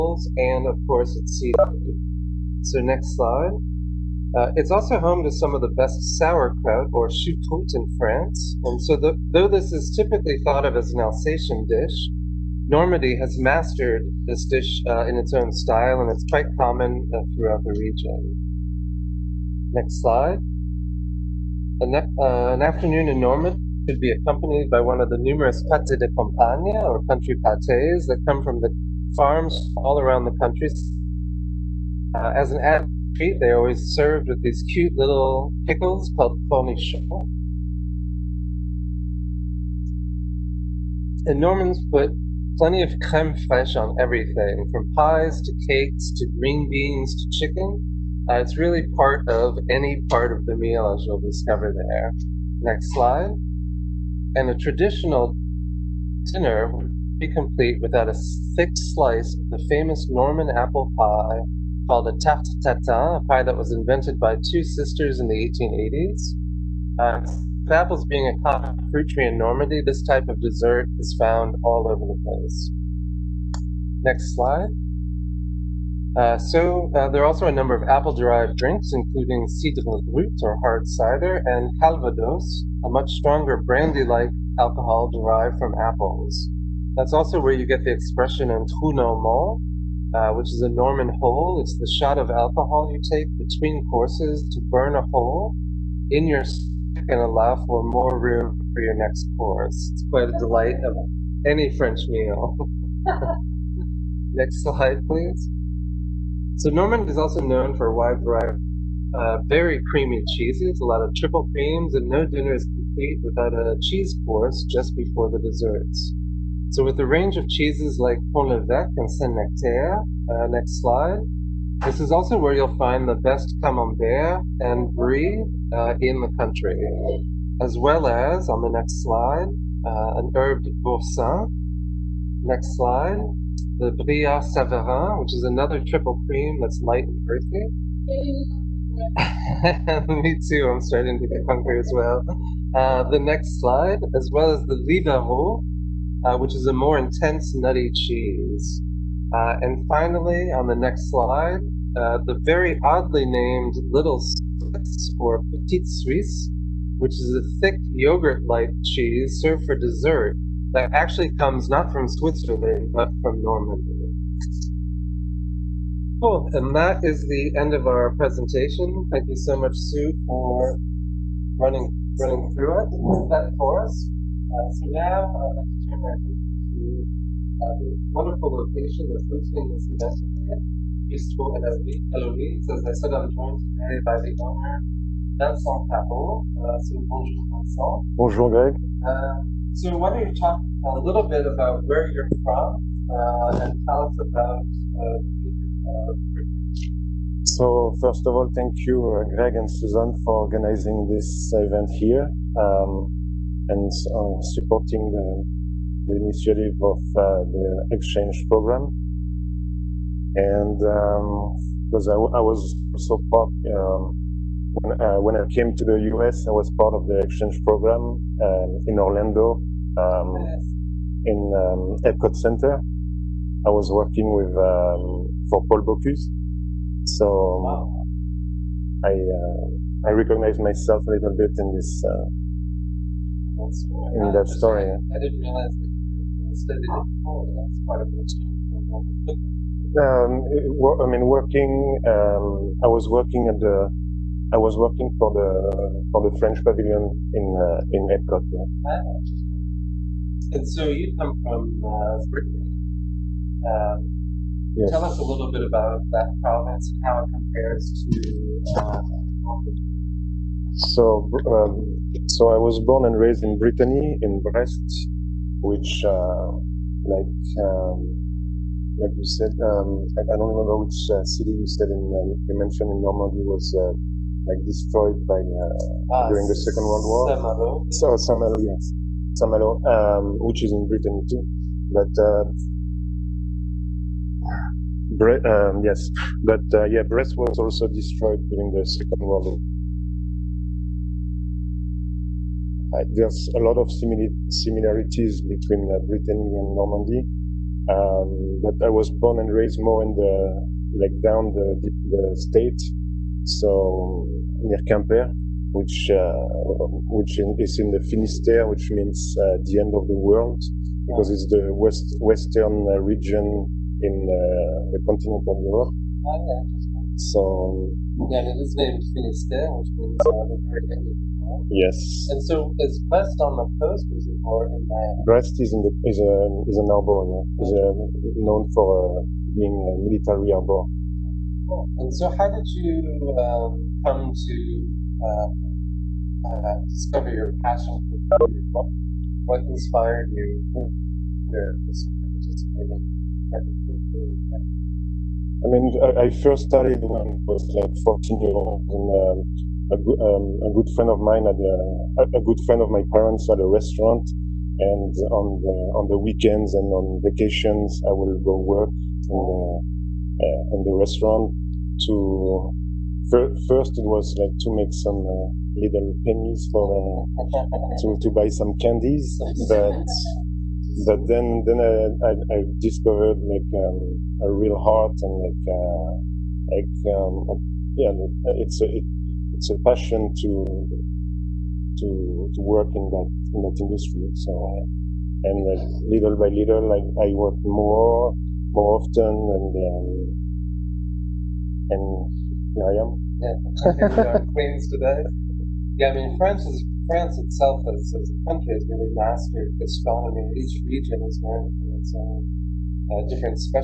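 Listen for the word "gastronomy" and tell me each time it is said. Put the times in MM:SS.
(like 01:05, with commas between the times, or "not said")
06:39.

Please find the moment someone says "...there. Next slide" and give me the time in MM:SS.
00:51.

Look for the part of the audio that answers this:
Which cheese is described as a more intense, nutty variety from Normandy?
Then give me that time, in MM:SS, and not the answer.
02:24.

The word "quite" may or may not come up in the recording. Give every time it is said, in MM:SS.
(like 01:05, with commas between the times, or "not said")
00:16, 01:40.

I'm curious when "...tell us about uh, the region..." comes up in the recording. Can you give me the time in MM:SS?
03:13.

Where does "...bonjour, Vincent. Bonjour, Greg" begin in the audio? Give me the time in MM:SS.
03:07.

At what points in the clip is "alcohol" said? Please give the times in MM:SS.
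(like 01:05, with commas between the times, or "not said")
01:24, 01:32.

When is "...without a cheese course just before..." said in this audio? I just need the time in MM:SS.
01:53.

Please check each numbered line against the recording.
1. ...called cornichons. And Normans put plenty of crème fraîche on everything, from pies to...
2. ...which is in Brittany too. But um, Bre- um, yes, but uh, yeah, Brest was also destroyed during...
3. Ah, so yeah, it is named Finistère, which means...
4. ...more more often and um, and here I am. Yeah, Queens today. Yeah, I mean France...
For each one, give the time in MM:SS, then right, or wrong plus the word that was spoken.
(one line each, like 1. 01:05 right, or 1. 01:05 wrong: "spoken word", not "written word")
1. 00:36 right
2. 04:40 right
3. 05:16 right
4. 06:27 right.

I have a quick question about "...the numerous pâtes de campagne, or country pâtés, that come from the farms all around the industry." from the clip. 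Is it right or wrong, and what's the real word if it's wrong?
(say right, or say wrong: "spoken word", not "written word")
wrong: "country", not "industry".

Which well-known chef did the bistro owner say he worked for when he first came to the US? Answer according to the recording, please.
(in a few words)
Paul Bocuse.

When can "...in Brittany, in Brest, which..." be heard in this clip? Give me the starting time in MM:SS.
04:23.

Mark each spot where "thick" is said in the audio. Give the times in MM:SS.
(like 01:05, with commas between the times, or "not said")
00:58, 02:37.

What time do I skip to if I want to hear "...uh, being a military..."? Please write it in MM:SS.
05:29.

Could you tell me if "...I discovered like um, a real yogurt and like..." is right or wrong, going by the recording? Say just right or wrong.
wrong.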